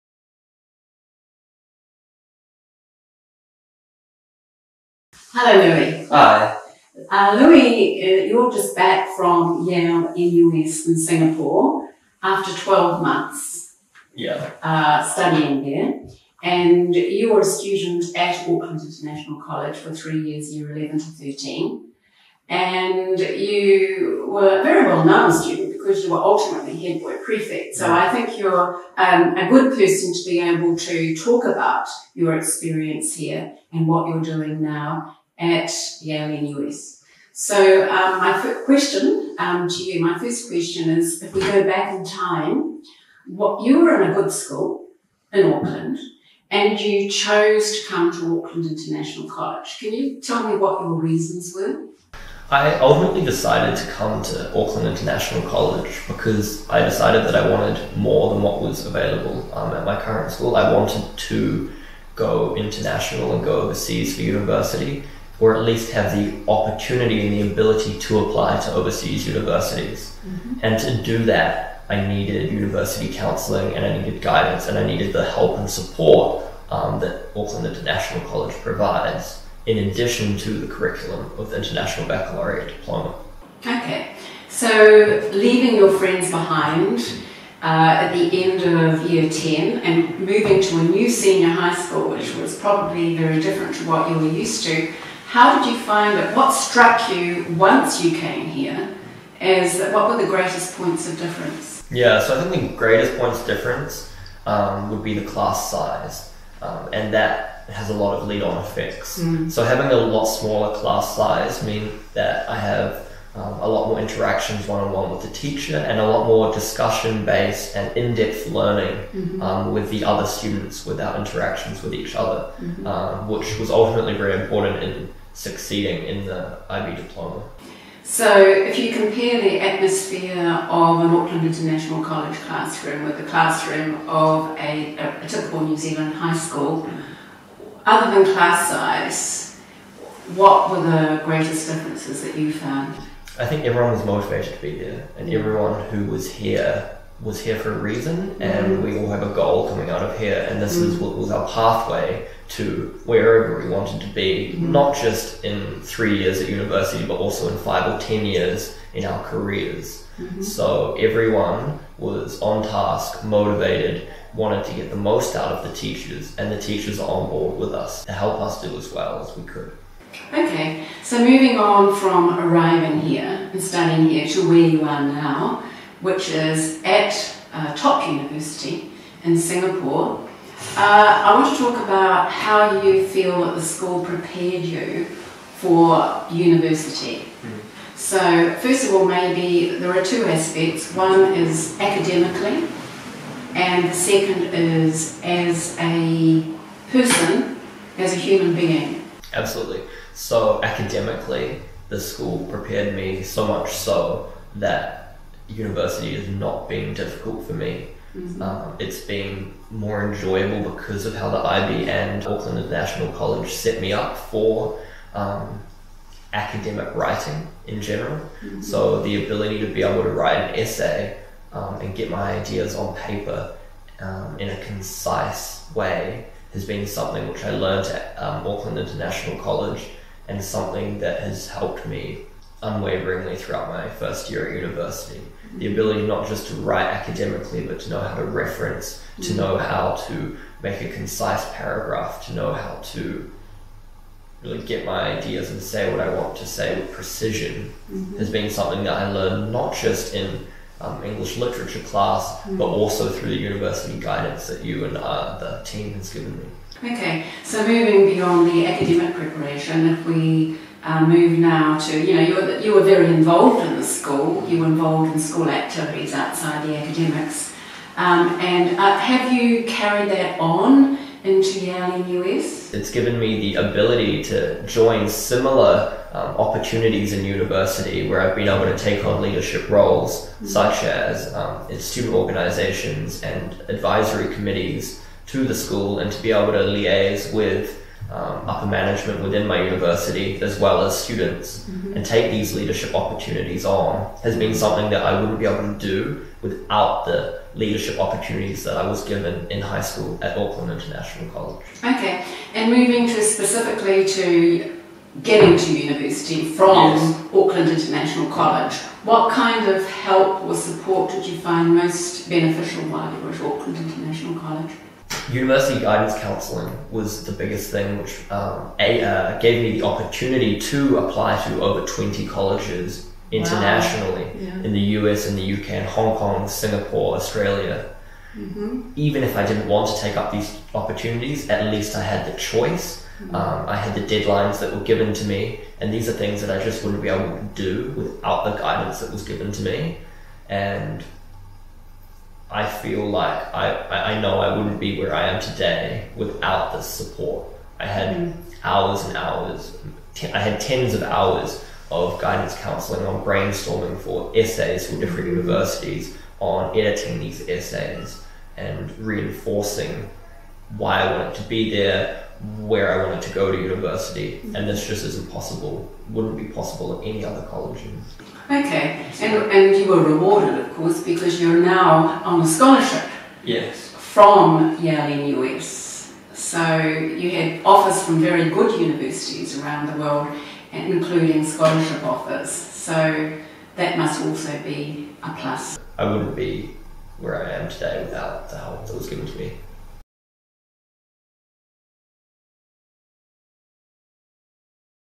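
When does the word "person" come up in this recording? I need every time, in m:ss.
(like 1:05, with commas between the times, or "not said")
0:29, 3:16.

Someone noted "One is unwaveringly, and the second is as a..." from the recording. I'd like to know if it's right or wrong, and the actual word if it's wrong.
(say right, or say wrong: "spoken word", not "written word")
wrong: "academically", not "unwaveringly".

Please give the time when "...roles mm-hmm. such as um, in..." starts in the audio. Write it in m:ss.
4:39.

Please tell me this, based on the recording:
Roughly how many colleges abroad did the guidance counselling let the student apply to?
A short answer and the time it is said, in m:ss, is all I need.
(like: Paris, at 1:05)
over 20, at 5:21.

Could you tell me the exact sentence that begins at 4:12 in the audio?
but also through the university guidance that you and uh, the team has given me.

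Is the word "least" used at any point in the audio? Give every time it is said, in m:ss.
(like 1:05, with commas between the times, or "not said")
1:05, 5:31.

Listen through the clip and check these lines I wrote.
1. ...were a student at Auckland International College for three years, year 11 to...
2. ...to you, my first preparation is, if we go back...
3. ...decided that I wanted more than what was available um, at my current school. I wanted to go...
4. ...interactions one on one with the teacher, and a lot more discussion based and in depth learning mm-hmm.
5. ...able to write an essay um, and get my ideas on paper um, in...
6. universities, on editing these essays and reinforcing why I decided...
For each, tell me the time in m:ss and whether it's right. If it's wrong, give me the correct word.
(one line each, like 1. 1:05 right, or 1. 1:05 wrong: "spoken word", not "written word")
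1. 0:17 right
2. 0:39 wrong: "question", not "preparation"
3. 0:56 right
4. 1:53 right
5. 3:39 right
6. 5:55 wrong: "wanted", not "decided".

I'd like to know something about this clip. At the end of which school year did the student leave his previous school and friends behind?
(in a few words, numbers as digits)
year 10.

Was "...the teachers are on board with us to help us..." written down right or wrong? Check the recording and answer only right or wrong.
right.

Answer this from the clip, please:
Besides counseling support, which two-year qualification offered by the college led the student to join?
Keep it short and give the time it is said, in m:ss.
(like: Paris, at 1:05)
International Baccalaureate Diploma, at 1:21.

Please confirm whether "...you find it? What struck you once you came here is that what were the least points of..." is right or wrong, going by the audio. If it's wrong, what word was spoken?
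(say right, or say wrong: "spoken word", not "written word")
wrong: "greatest", not "least".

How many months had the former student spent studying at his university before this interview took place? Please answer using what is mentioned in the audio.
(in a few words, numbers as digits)
12.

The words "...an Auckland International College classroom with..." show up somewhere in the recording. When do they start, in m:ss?
2:10.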